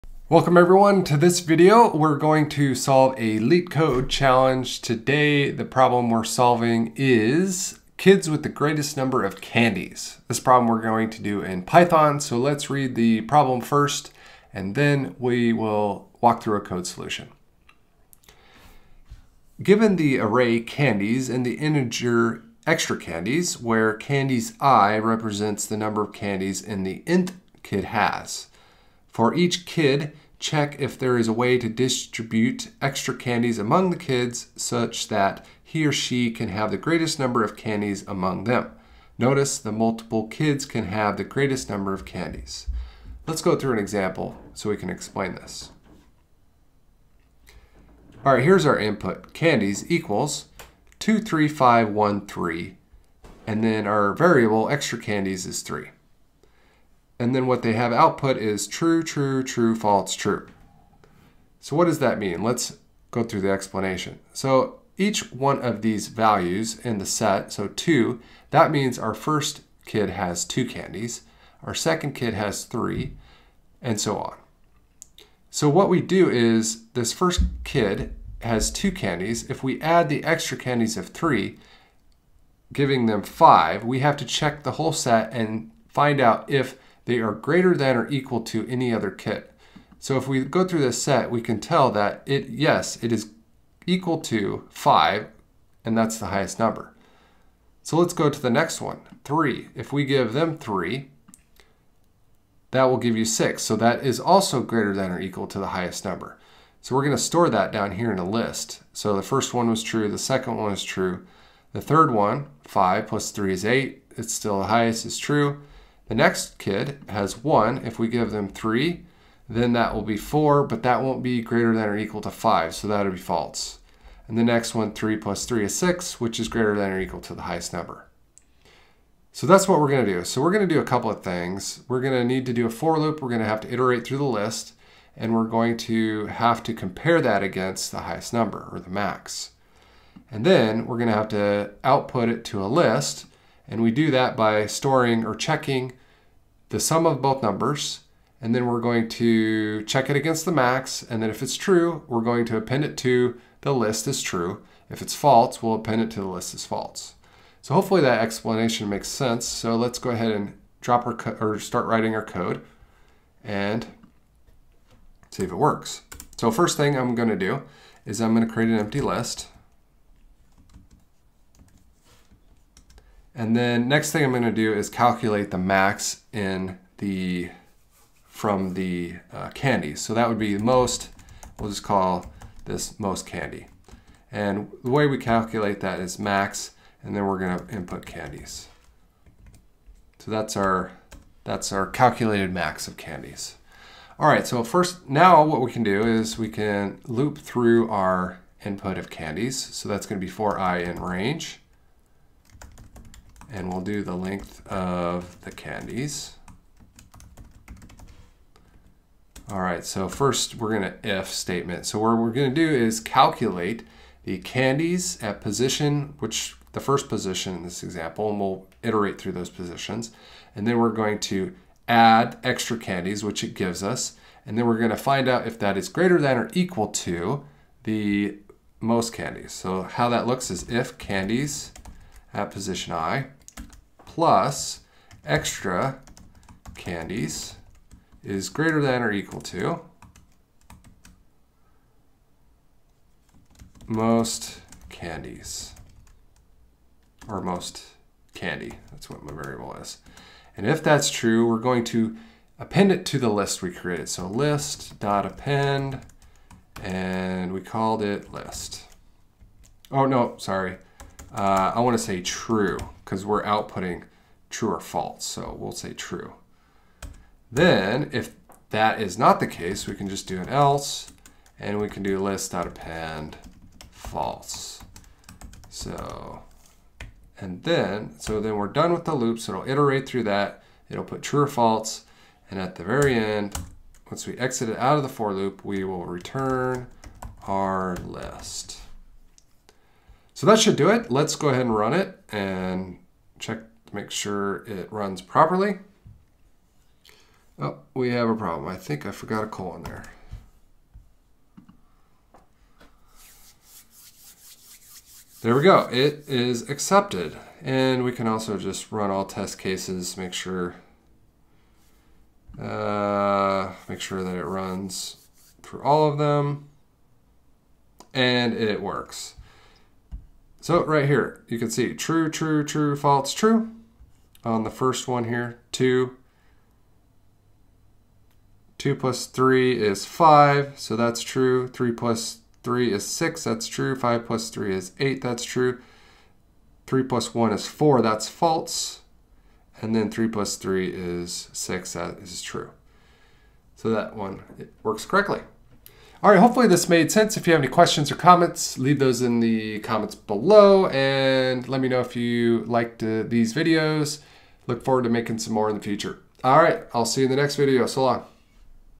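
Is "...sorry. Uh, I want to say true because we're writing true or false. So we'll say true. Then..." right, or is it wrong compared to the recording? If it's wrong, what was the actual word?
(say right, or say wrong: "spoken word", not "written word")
wrong: "outputting", not "writing".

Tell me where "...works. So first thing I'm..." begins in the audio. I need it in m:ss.
2:45.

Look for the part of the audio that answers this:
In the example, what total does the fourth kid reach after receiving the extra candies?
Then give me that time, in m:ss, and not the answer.
2:00.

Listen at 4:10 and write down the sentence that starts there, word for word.
And if that's true, we're going to append it to the list we created.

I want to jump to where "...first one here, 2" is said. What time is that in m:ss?
5:24.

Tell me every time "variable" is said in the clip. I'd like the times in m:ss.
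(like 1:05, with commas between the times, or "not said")
0:54, 4:09.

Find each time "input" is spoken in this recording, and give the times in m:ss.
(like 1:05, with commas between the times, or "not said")
0:48, 3:07, 3:18.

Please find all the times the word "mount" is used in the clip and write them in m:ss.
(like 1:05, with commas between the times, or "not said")
not said.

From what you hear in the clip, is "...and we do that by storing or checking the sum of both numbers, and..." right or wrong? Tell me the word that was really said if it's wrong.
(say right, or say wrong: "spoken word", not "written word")
right.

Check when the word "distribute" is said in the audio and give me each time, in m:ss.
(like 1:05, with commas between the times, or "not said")
0:31.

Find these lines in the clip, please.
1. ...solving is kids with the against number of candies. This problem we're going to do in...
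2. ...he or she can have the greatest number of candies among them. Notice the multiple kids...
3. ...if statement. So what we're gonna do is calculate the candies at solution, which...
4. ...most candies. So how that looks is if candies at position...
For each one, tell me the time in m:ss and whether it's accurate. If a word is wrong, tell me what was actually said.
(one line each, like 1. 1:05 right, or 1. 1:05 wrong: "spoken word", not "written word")
1. 0:06 wrong: "greatest", not "against"
2. 0:35 right
3. 3:31 wrong: "position", not "solution"
4. 3:48 right.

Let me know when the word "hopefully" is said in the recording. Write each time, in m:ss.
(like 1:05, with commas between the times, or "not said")
2:37, 5:46.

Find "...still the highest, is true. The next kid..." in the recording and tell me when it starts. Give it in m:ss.
1:54.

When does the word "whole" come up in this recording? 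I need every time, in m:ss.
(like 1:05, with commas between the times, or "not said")
1:24.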